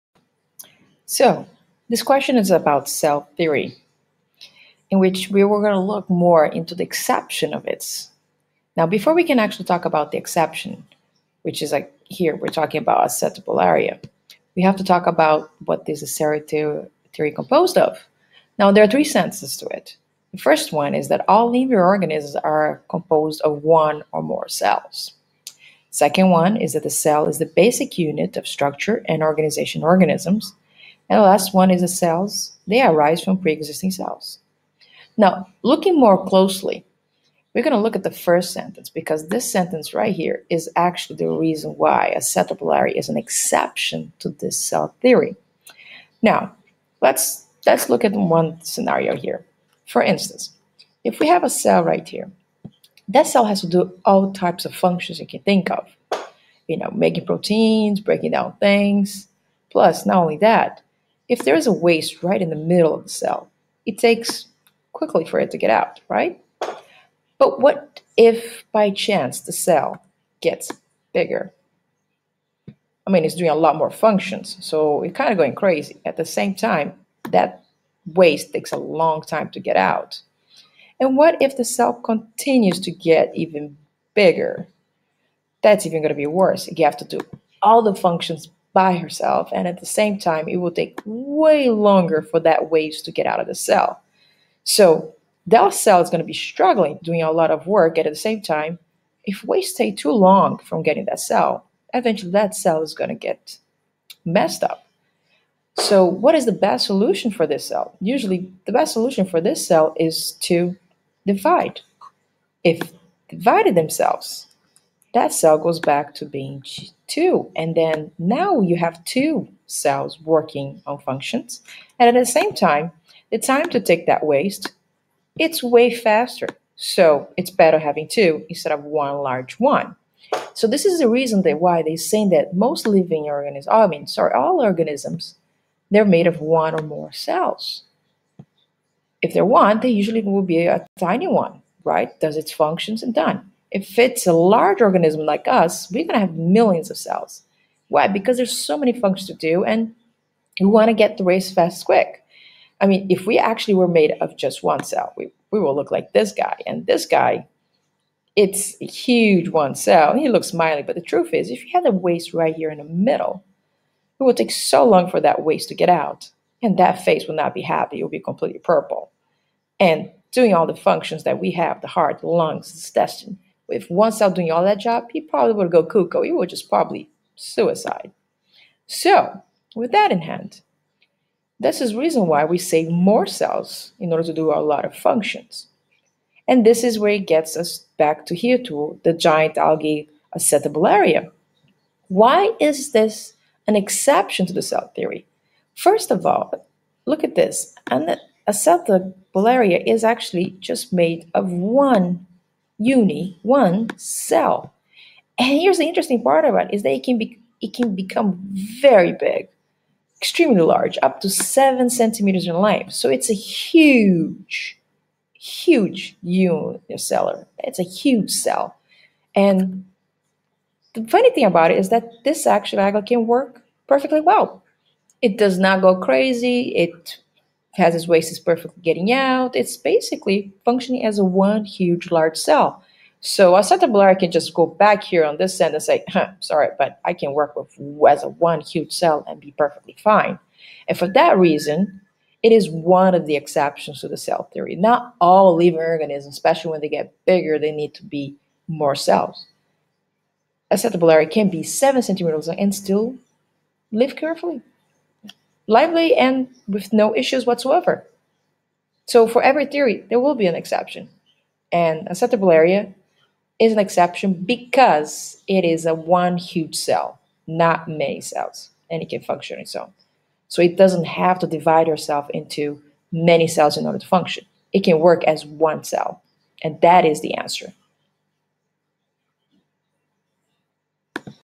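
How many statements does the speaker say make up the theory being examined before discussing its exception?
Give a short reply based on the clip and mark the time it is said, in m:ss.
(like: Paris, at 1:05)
3, at 0:18.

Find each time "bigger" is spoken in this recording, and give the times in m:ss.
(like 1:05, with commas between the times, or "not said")
1:11, 1:24, 4:07.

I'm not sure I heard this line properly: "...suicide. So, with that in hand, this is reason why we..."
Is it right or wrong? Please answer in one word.
right.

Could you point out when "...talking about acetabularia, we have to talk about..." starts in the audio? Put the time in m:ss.
0:12.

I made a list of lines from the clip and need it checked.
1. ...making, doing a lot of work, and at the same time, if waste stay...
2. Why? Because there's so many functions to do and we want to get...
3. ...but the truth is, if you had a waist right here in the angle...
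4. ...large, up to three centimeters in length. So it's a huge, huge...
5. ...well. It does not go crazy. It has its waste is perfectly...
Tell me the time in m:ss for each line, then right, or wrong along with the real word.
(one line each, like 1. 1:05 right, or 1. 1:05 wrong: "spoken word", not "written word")
1. 1:36 wrong: "struggling", not "making"
2. 2:27 right
3. 2:40 wrong: "middle", not "angle"
4. 3:30 wrong: "seven", not "three"
5. 3:44 right.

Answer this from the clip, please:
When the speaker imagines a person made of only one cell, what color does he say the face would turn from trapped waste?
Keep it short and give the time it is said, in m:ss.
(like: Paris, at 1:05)
Purple, at 2:48.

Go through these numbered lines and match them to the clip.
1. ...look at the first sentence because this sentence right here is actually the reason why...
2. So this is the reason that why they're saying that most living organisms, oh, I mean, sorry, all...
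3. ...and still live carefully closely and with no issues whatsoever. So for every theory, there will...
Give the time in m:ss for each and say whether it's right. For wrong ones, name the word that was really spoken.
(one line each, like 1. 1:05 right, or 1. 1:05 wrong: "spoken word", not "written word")
1. 0:37 right
2. 2:10 right
3. 4:12 wrong: "lively", not "closely".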